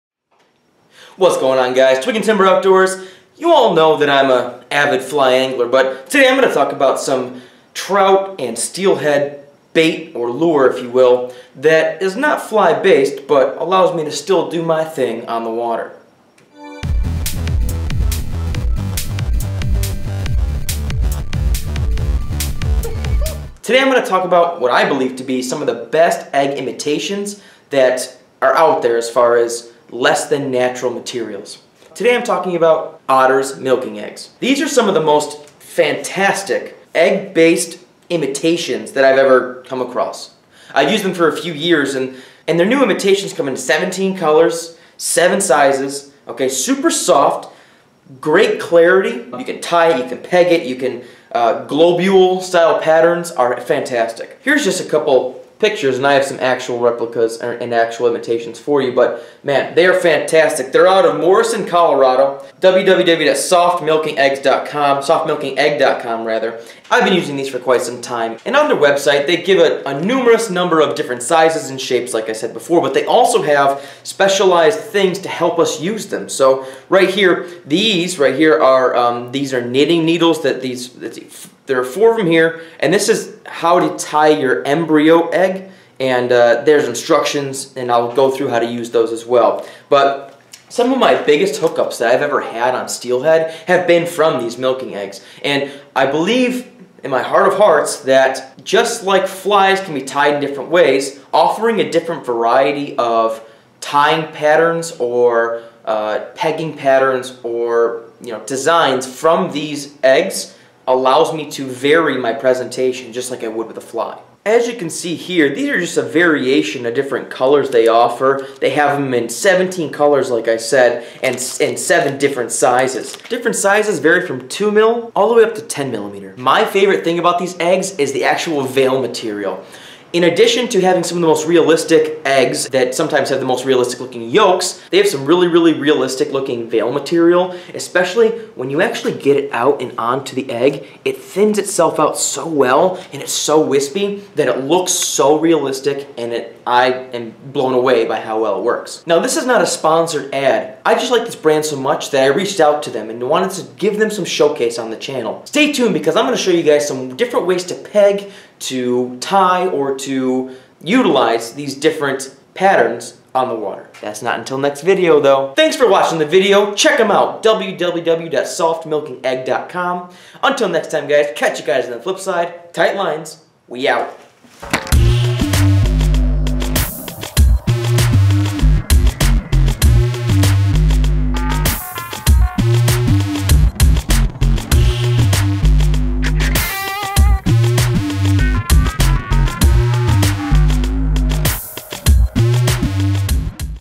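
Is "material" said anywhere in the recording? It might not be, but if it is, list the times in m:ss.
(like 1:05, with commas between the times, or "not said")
0:30, 2:08, 2:16.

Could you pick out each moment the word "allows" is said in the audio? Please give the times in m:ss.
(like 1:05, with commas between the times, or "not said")
0:13, 1:50.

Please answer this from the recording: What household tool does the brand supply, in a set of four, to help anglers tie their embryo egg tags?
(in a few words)
Knitting needles.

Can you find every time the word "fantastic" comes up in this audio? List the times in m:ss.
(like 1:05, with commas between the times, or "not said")
0:35, 0:53, 0:59.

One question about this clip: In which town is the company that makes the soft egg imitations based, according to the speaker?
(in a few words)
Morrison, Colorado.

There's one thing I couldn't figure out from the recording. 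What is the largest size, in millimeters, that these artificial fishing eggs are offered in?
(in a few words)
10 millimeters.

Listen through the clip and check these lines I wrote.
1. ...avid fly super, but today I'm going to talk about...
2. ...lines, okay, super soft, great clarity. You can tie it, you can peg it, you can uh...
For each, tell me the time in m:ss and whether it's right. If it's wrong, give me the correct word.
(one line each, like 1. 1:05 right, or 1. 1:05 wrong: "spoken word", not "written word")
1. 0:04 wrong: "angler", not "super"
2. 0:45 wrong: "sizes", not "lines".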